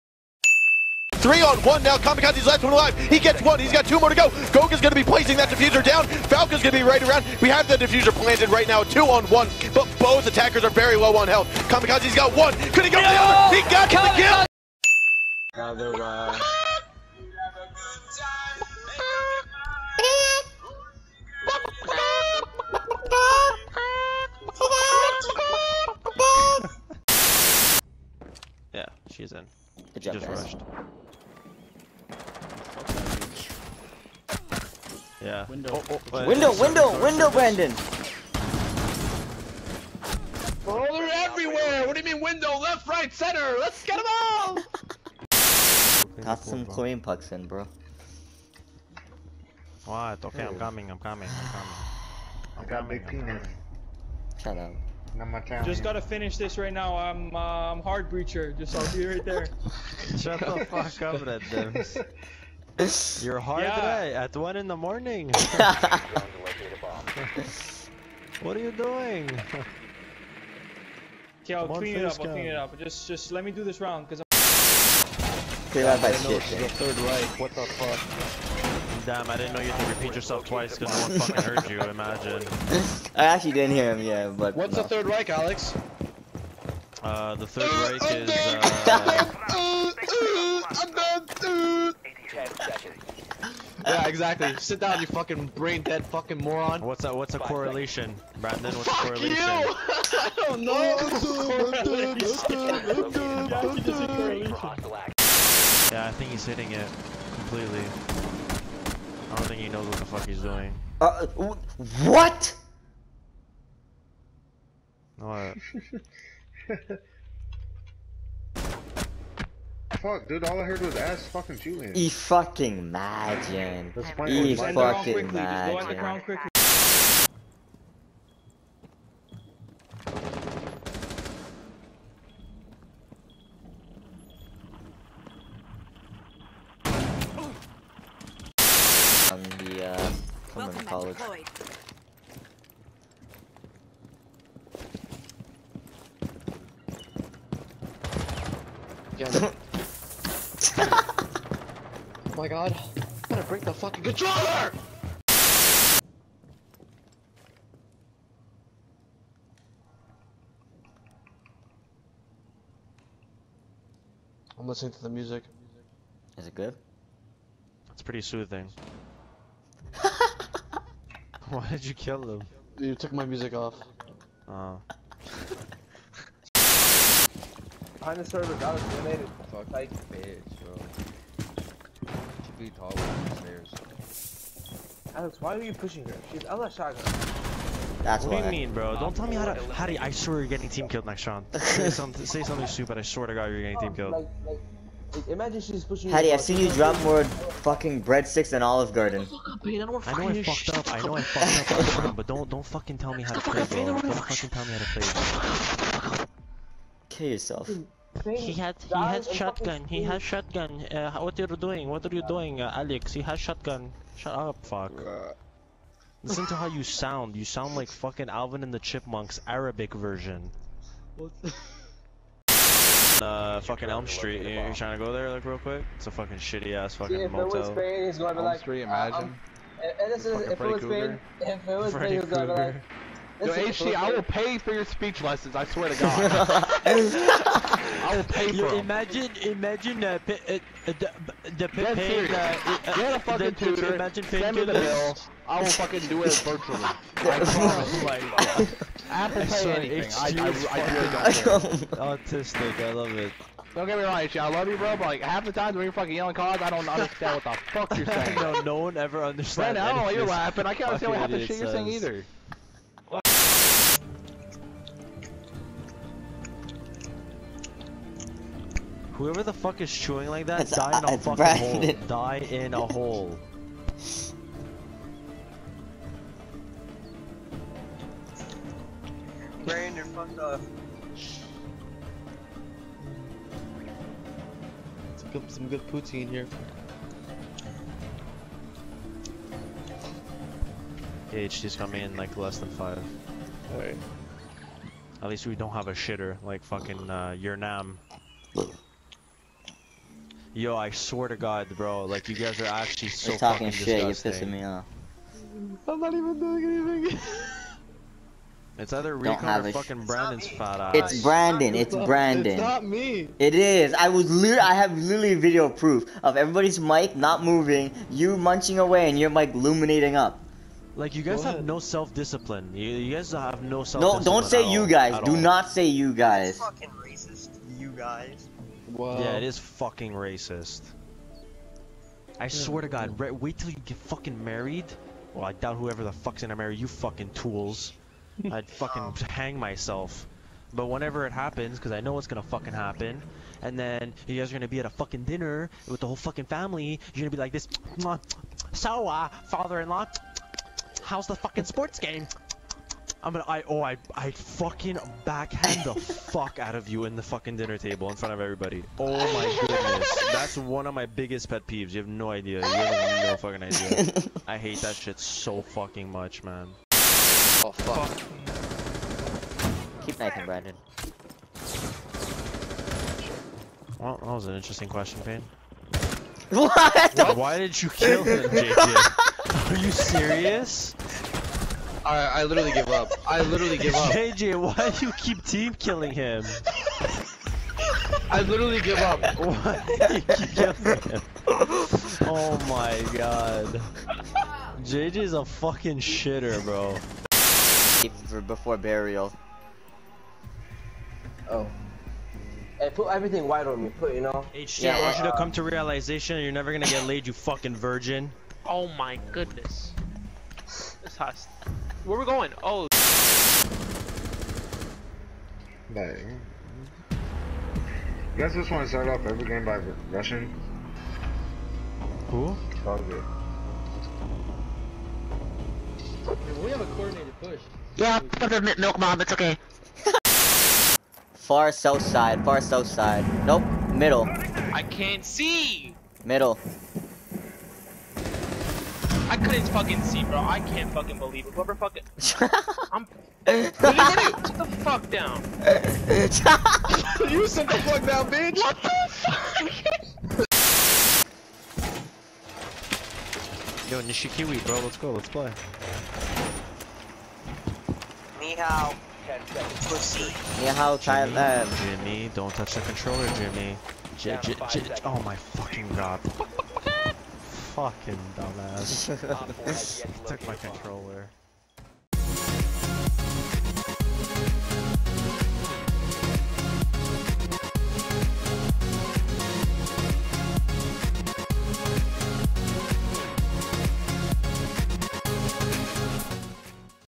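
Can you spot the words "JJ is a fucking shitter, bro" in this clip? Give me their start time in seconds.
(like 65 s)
394 s.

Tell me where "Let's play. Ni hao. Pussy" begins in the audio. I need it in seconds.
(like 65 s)
455 s.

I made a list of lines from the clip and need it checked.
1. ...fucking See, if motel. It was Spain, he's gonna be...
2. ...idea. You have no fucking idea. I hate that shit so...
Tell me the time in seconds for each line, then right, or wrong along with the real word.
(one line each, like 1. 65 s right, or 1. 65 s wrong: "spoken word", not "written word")
1. 226 s right
2. 362 s right.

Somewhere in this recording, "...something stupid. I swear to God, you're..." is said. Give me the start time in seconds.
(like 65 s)
192 s.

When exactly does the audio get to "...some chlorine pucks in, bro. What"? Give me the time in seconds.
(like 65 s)
46 s.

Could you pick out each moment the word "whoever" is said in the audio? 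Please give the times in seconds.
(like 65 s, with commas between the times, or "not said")
269 s, 335 s, 441 s.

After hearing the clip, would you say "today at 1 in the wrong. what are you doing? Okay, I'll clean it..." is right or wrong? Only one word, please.
wrong.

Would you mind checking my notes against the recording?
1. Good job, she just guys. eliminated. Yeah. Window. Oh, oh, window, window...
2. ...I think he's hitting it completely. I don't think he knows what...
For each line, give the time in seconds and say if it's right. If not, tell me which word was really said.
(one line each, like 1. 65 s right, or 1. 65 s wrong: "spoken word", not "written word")
1. 29 s wrong: "rushed", not "eliminated"
2. 106 s right.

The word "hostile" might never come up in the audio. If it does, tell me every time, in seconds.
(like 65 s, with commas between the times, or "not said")
411 s.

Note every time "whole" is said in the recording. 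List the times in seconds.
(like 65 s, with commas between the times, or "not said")
346 s.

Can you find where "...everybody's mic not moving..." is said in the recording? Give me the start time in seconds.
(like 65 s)
316 s.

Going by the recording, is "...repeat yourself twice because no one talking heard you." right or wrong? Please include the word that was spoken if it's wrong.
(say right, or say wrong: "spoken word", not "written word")
wrong: "fucking", not "talking".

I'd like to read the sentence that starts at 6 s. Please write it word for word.
Falco's going to be right around.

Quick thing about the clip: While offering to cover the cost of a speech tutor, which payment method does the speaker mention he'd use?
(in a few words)
Apple Pay.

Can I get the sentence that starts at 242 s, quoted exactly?
Uh, uh, Get a fucking the, tutor.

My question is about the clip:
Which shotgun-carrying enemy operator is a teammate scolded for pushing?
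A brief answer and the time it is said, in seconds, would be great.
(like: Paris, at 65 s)
Ela, at 186 s.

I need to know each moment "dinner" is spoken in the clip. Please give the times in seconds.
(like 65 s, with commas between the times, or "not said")
345 s, 357 s.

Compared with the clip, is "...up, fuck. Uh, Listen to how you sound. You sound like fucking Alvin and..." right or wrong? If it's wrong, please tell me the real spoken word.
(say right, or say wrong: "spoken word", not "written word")
right.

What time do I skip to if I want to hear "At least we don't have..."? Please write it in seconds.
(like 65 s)
295 s.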